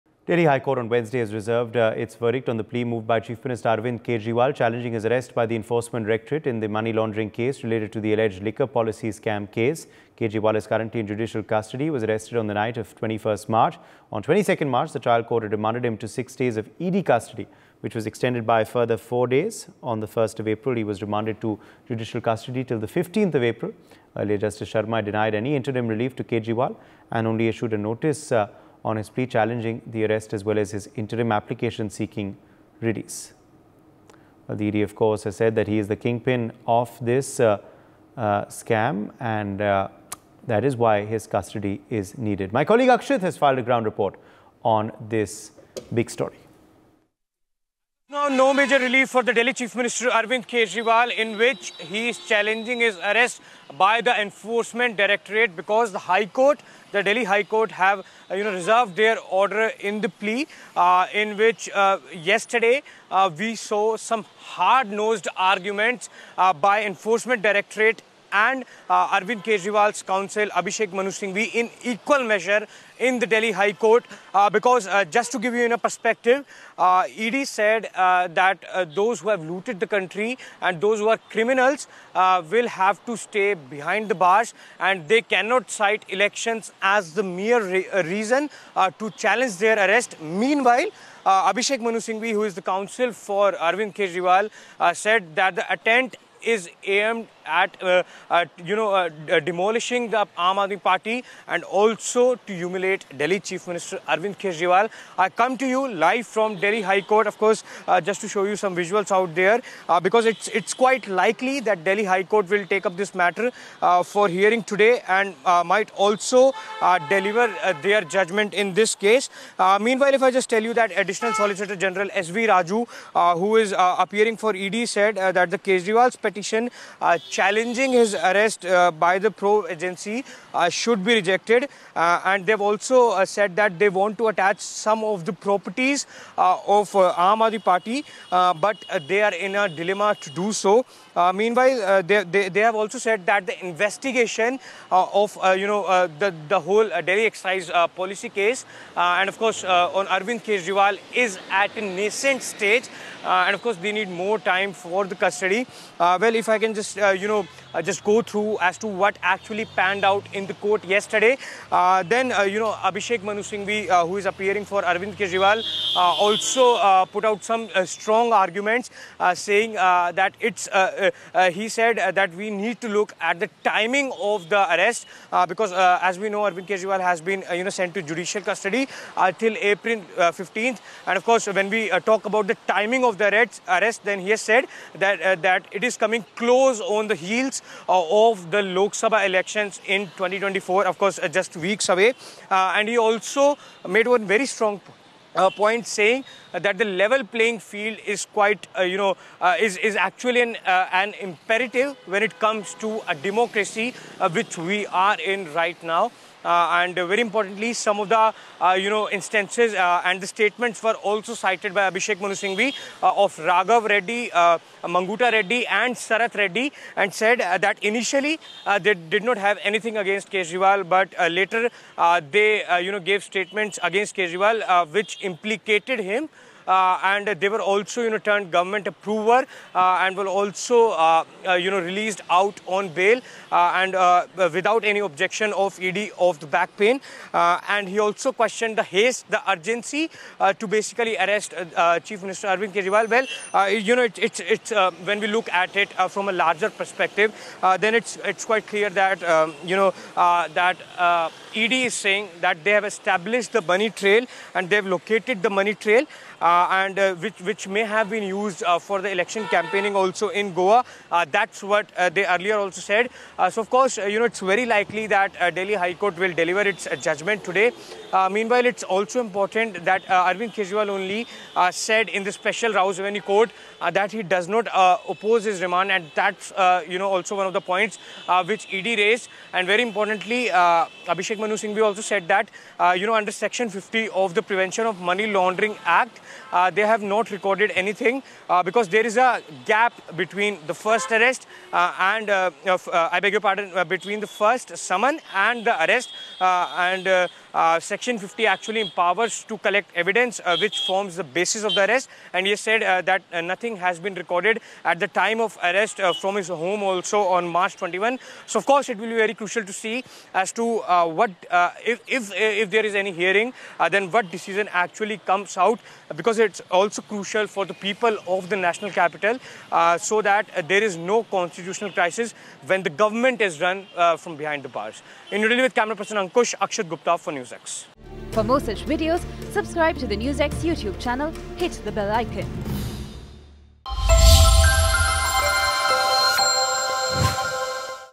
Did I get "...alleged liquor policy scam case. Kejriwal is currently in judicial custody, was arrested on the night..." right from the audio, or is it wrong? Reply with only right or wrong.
right.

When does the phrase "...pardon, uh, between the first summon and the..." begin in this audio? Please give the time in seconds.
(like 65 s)
293 s.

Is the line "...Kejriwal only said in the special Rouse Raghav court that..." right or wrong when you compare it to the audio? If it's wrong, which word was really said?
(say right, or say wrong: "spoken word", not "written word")
wrong: "Avenue", not "Raghav".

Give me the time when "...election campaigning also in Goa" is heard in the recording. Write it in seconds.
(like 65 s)
259 s.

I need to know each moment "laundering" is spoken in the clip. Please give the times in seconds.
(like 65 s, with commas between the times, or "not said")
6 s, 285 s.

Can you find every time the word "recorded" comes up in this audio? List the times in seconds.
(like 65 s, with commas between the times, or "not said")
287 s, 304 s.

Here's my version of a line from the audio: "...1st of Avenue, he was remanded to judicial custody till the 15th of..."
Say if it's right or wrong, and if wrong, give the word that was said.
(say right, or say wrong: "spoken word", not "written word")
wrong: "April", not "Avenue".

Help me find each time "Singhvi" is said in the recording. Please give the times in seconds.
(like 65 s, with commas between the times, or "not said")
71 s, 91 s, 163 s, 212 s, 281 s.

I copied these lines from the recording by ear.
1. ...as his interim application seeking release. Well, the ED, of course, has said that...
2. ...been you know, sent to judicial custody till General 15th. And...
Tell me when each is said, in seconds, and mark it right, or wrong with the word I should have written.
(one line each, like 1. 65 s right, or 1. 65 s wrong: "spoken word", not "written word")
1. 30 s right
2. 177 s wrong: "April", not "General".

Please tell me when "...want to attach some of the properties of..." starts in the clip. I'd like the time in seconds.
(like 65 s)
133 s.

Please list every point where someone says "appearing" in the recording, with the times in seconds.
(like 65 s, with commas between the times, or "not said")
123 s, 164 s.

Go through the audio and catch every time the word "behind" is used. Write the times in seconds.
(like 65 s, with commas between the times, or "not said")
83 s, 324 s.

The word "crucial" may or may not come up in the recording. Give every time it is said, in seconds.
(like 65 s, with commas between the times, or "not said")
309 s, 317 s.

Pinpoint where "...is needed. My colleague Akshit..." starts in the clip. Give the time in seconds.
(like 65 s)
41 s.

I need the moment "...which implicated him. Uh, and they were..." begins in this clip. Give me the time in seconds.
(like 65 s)
224 s.